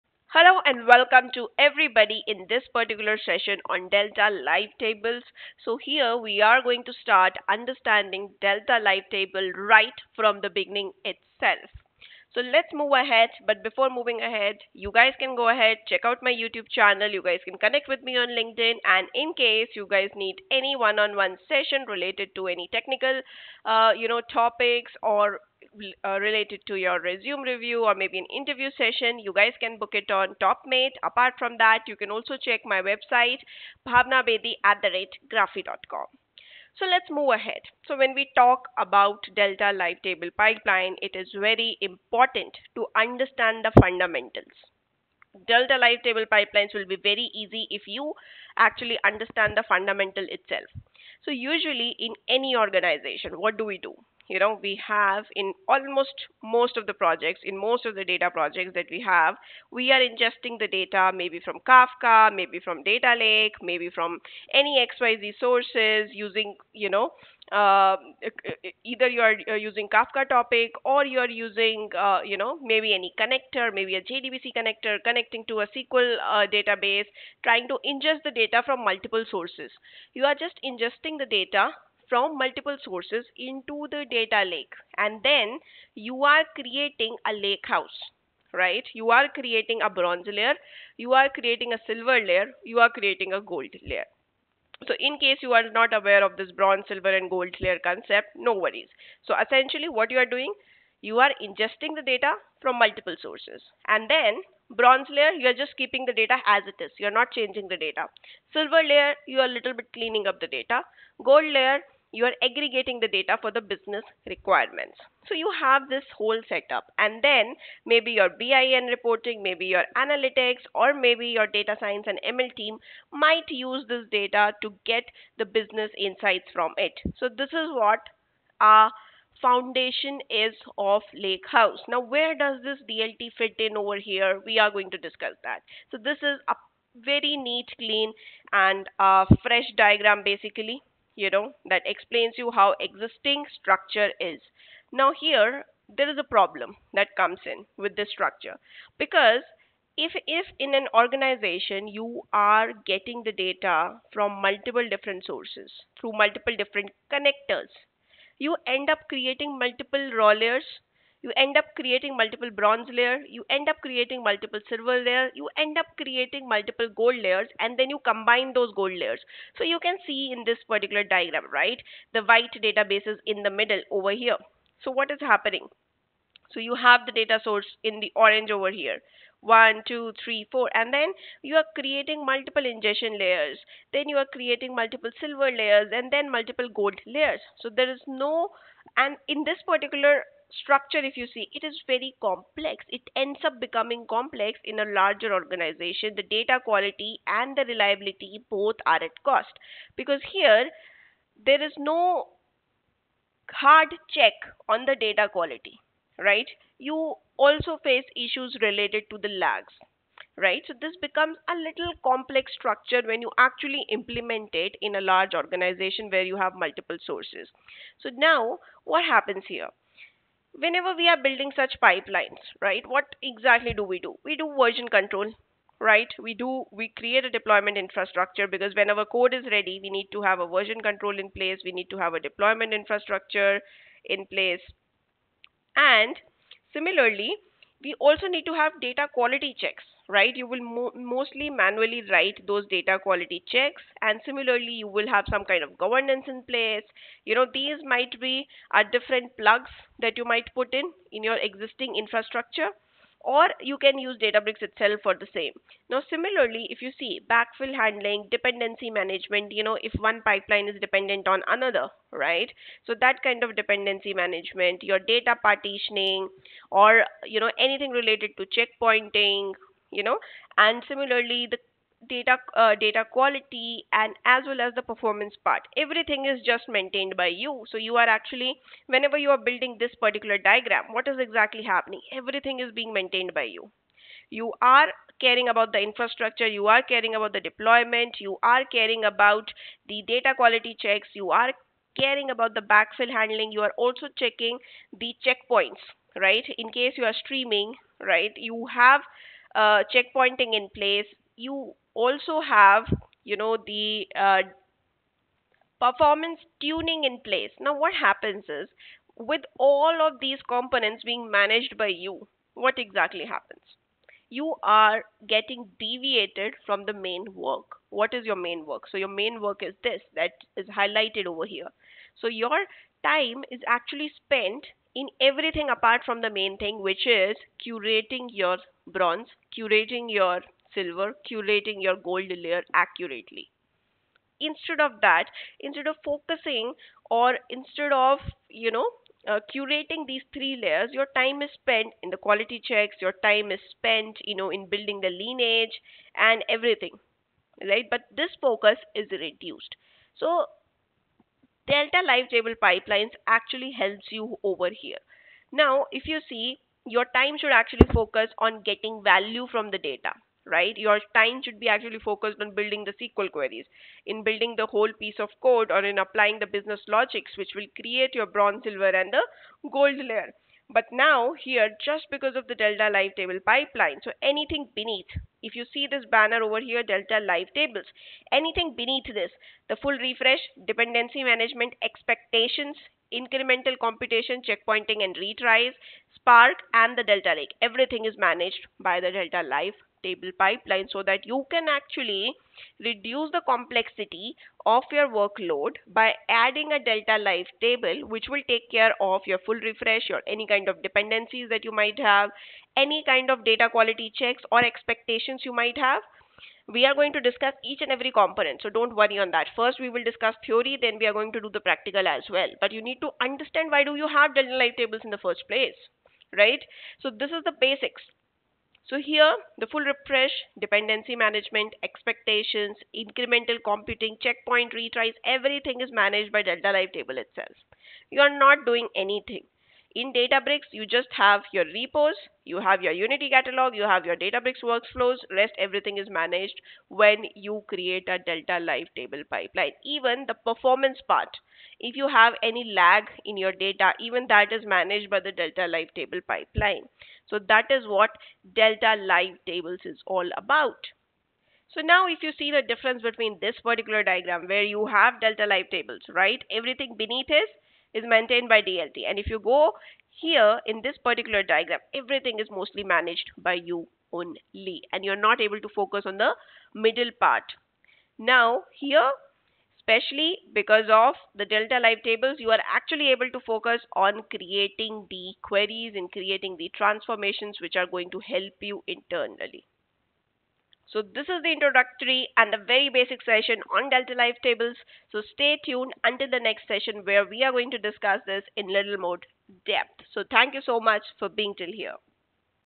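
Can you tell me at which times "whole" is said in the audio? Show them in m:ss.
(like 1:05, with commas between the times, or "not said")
1:56, 6:04.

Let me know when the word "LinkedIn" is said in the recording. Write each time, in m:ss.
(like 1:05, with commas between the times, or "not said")
0:18.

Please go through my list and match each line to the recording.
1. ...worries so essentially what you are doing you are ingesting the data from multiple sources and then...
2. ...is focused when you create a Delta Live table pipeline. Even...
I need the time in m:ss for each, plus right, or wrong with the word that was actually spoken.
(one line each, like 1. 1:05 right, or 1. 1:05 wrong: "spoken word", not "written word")
1. 1:38 right
2. 7:15 wrong: "managed", not "focused".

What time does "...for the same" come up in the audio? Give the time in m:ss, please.
4:15.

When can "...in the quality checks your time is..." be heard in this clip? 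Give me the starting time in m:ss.
5:42.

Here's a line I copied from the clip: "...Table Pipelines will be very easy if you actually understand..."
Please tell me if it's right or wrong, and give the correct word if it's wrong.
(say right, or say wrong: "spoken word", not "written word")
right.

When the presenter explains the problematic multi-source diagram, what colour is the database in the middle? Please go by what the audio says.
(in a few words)
White.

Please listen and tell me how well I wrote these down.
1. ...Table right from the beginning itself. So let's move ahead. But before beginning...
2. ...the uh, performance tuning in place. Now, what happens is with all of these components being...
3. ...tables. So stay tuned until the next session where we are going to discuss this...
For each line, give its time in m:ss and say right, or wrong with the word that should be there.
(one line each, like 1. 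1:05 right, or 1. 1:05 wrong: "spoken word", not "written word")
1. 0:09 wrong: "moving", not "beginning"
2. 5:03 right
3. 8:04 right.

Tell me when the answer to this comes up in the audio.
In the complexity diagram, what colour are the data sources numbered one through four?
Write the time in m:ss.
2:58.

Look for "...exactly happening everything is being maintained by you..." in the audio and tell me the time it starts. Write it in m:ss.
4:41.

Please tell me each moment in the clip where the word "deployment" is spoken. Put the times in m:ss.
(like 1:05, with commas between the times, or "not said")
3:47, 3:52, 4:47.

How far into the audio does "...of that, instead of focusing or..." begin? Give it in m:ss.
5:34.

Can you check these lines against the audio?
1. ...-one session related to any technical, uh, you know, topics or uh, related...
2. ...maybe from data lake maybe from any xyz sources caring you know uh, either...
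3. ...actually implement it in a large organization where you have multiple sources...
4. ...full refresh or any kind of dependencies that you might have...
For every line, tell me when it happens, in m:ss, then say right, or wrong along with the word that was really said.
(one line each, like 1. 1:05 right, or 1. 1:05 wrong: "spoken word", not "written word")
1. 0:21 right
2. 1:02 wrong: "using", not "caring"
3. 3:33 right
4. 6:39 right.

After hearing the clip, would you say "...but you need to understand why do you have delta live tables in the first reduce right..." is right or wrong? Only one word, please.
wrong.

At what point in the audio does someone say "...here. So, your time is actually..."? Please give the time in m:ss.
5:21.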